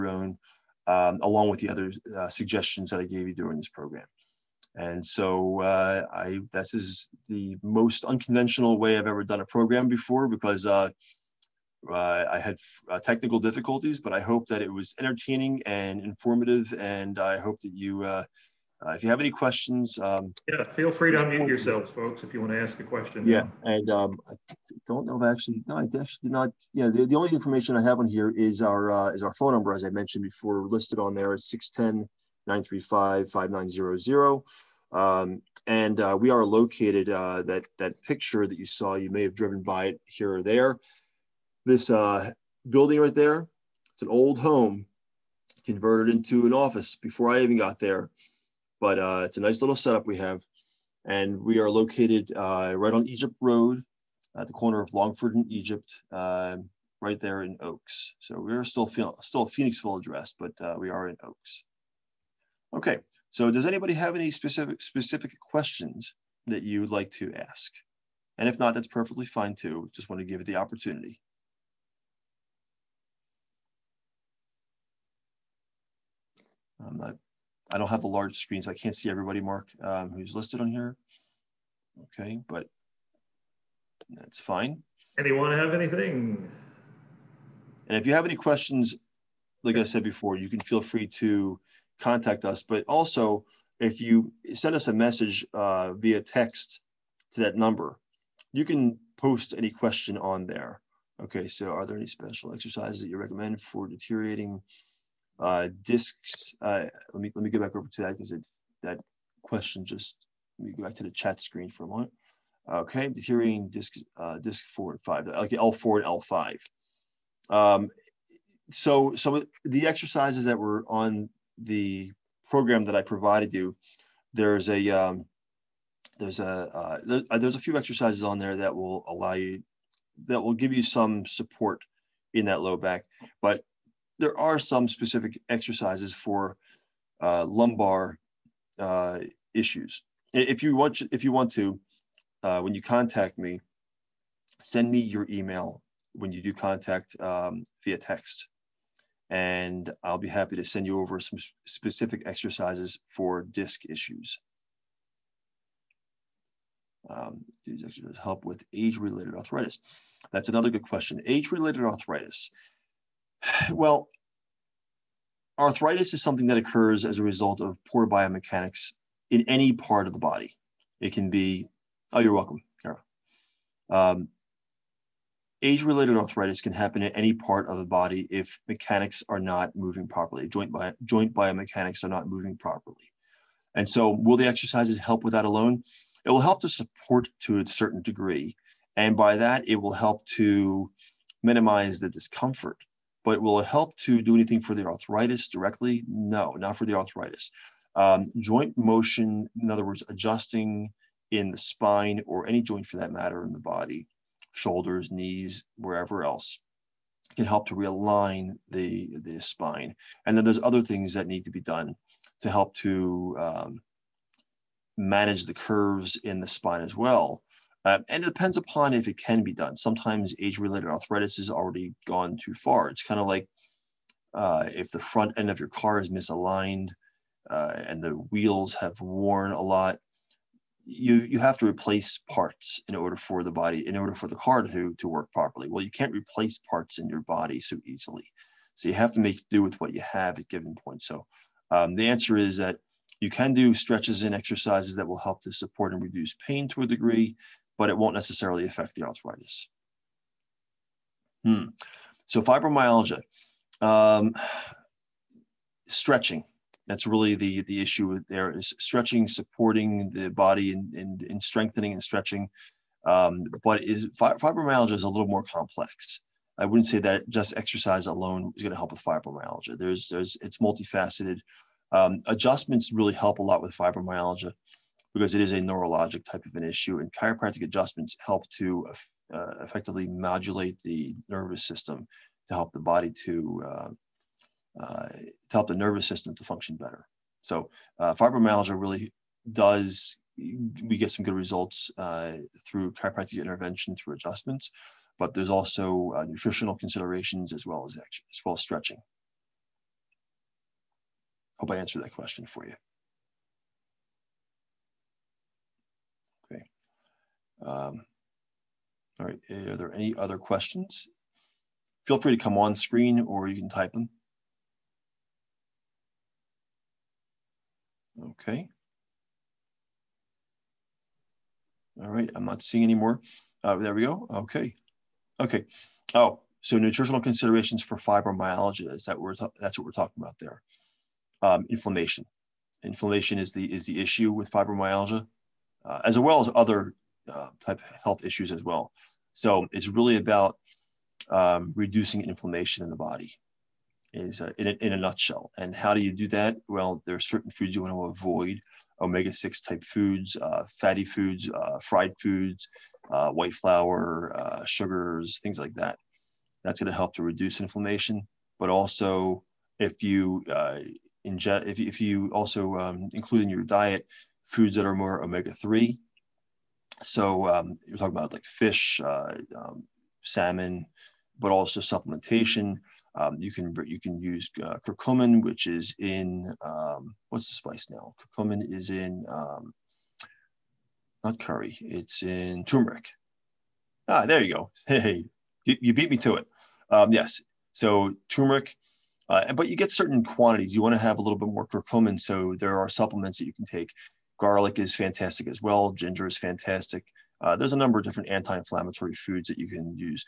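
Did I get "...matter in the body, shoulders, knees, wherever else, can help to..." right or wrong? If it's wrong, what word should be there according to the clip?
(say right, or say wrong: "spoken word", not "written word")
right.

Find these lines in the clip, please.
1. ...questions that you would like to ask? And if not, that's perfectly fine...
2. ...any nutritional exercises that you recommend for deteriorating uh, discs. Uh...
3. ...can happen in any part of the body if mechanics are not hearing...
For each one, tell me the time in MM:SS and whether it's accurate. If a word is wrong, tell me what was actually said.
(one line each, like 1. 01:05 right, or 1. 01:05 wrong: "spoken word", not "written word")
1. 01:05 right
2. 01:41 wrong: "special", not "nutritional"
3. 02:56 wrong: "moving", not "hearing".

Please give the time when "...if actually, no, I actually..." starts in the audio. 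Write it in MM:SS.
00:25.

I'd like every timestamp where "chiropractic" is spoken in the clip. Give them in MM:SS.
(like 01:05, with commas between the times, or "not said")
04:37, 04:52.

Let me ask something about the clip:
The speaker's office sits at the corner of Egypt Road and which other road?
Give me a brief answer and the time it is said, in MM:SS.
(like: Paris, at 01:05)
Longford, at 00:54.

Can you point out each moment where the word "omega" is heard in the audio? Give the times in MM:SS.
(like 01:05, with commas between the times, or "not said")
05:49, 06:05.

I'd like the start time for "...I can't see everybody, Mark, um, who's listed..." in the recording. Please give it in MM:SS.
01:18.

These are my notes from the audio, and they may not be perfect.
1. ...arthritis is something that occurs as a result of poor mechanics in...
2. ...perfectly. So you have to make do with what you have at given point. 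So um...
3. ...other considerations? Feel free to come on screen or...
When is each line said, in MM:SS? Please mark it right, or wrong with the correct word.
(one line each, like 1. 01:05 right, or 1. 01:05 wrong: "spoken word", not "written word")
1. 02:45 wrong: "biomechanics", not "mechanics"
2. 03:57 wrong: "easily", not "perfectly"
3. 05:10 wrong: "questions", not "considerations".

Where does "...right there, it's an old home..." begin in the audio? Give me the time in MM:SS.
00:43.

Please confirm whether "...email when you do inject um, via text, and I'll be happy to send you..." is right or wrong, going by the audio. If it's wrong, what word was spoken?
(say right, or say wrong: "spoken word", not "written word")
wrong: "contact", not "inject".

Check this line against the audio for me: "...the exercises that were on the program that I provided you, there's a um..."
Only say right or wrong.
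right.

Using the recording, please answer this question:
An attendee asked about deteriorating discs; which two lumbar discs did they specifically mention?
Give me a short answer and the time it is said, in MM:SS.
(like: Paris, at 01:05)
L4 and L5, at 01:55.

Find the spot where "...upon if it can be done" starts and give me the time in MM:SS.
03:38.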